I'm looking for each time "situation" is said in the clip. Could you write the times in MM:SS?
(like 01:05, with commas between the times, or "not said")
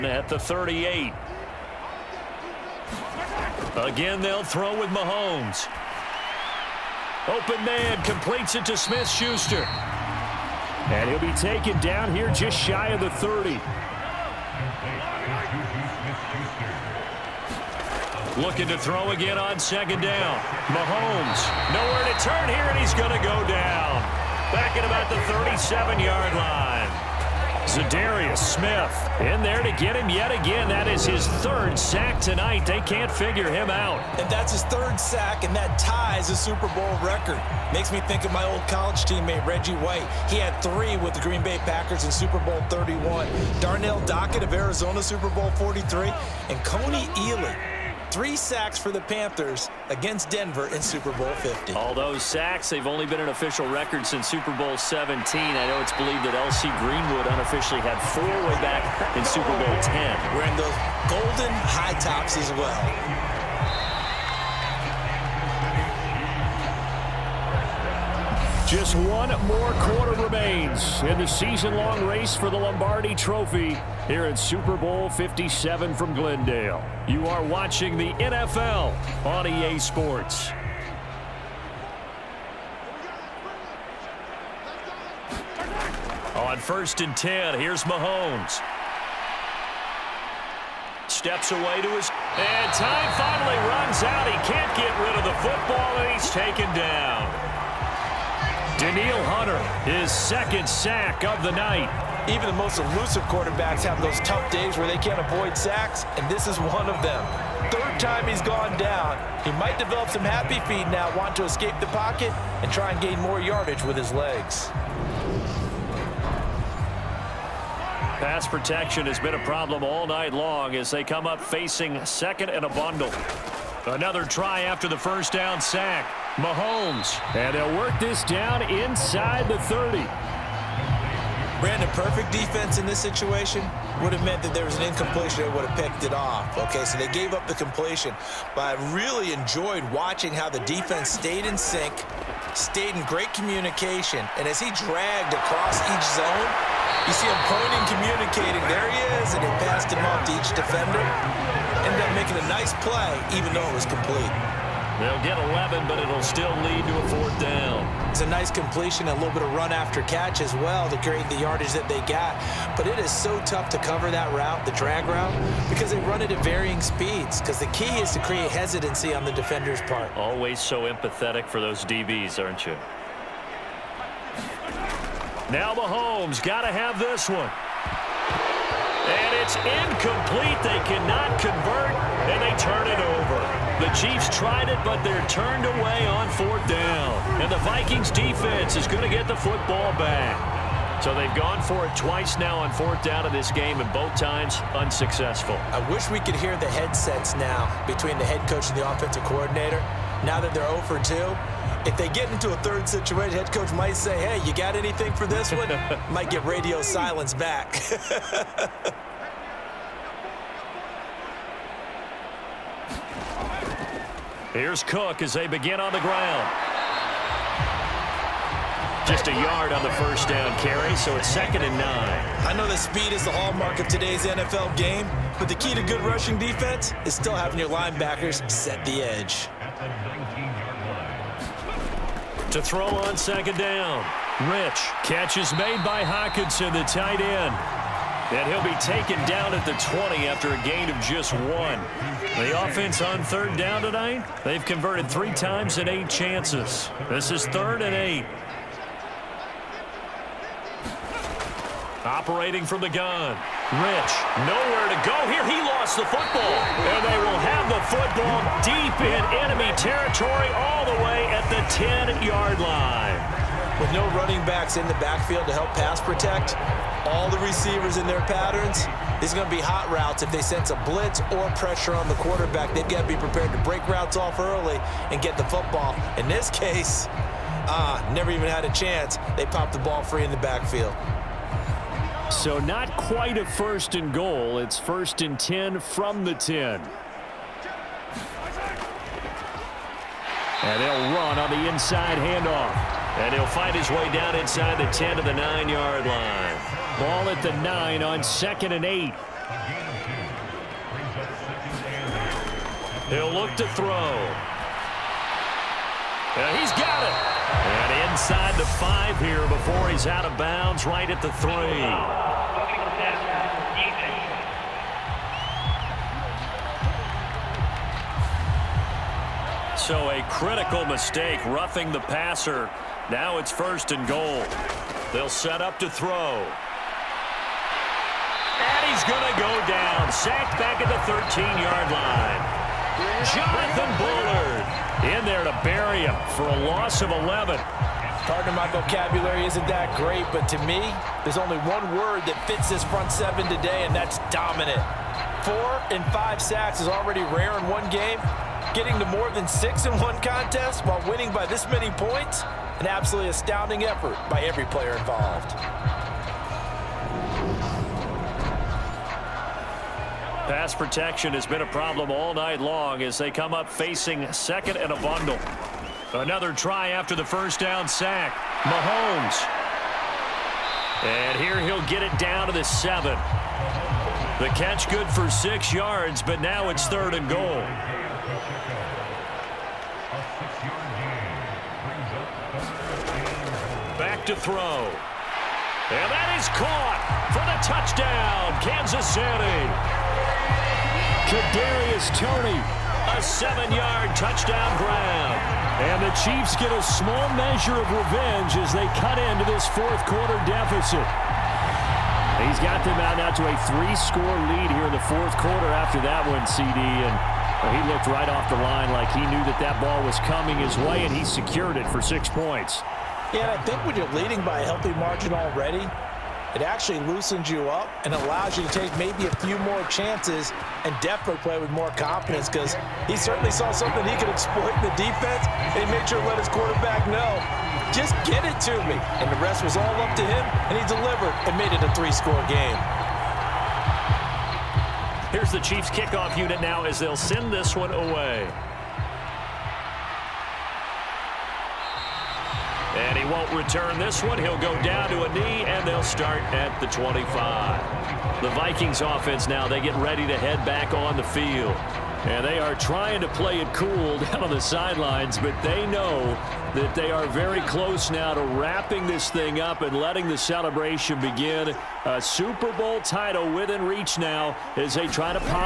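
02:12, 03:22.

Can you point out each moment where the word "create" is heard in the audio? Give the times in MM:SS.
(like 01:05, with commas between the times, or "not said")
02:40, 02:48.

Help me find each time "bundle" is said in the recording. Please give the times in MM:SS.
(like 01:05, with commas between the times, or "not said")
02:02, 06:04.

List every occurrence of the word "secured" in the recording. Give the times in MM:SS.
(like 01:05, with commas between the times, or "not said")
06:51.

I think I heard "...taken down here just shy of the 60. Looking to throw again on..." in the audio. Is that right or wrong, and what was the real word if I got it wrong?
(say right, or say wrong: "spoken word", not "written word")
wrong: "30", not "60".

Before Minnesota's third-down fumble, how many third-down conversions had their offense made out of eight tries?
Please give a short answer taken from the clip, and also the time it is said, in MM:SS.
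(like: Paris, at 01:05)
3, at 04:05.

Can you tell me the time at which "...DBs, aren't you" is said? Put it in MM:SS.
02:51.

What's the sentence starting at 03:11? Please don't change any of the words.
So they've gone for it twice now on fourth down of this game, and both times unsuccessful.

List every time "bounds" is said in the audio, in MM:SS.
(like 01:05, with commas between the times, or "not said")
05:10.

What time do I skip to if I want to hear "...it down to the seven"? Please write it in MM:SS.
06:12.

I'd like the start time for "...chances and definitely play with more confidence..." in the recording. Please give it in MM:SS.
06:59.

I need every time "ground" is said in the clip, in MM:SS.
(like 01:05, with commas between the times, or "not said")
03:36.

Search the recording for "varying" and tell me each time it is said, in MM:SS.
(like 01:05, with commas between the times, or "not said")
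02:46.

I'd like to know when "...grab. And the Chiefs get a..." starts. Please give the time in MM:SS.
06:34.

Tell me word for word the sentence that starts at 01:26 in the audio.
On first and 10, here's Mahomes.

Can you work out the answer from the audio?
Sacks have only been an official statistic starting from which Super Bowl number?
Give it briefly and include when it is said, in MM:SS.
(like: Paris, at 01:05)
17, at 00:54.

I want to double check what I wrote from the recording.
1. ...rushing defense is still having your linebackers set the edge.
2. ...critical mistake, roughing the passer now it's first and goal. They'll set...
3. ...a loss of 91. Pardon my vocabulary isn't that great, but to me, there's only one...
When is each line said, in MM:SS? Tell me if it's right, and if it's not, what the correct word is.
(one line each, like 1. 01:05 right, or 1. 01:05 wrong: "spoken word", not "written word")
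1. 03:46 right
2. 05:20 right
3. 05:36 wrong: "11", not "91".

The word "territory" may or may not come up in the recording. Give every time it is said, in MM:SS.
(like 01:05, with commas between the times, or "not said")
04:19.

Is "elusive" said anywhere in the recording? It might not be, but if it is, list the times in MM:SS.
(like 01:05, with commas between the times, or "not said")
01:42.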